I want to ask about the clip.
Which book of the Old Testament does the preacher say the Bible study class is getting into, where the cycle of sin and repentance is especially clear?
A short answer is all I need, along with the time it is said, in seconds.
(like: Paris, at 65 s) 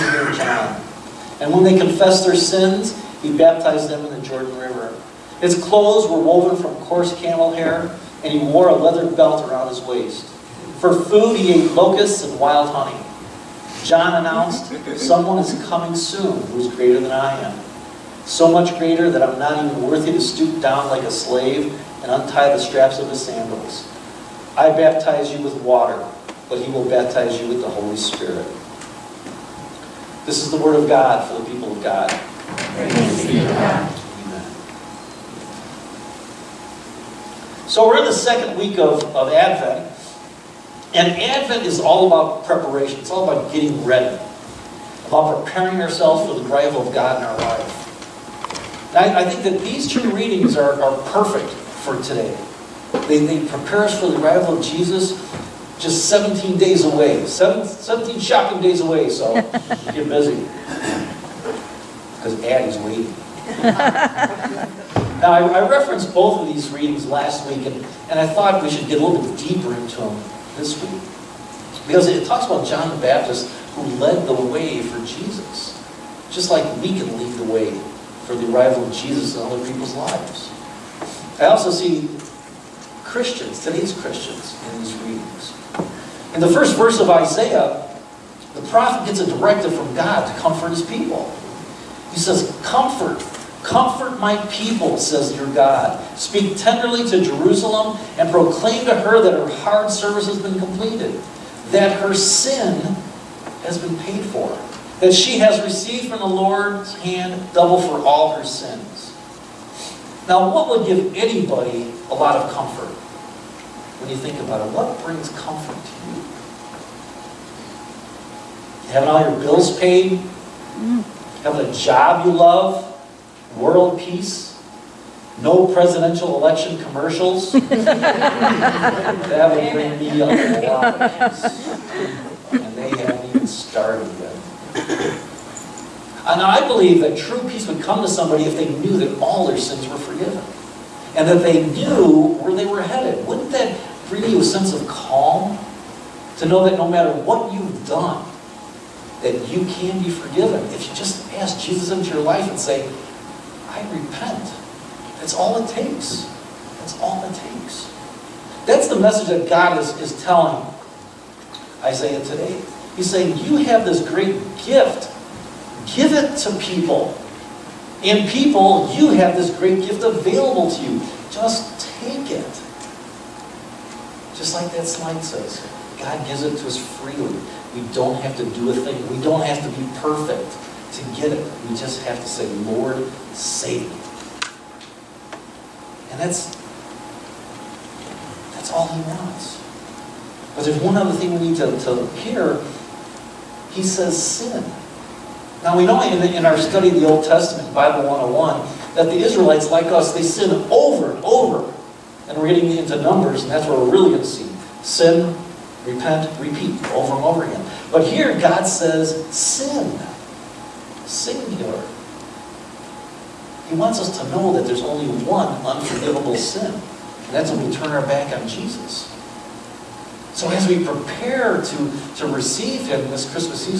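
Numbers, at 203 s.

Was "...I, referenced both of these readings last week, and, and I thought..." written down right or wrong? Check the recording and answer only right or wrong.
right.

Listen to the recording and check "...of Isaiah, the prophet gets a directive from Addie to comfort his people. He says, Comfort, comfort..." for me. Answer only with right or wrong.
wrong.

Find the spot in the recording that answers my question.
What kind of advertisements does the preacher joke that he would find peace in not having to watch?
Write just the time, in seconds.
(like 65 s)
125 s.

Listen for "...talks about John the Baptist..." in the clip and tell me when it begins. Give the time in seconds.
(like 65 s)
72 s.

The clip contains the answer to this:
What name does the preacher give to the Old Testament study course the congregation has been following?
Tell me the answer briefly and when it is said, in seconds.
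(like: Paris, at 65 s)
Bible 101, at 197 s.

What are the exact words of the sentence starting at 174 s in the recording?
Just like that slide says, God gives it to us freely.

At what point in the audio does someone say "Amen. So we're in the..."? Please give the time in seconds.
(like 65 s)
34 s.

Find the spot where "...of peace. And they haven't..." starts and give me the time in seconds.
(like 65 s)
131 s.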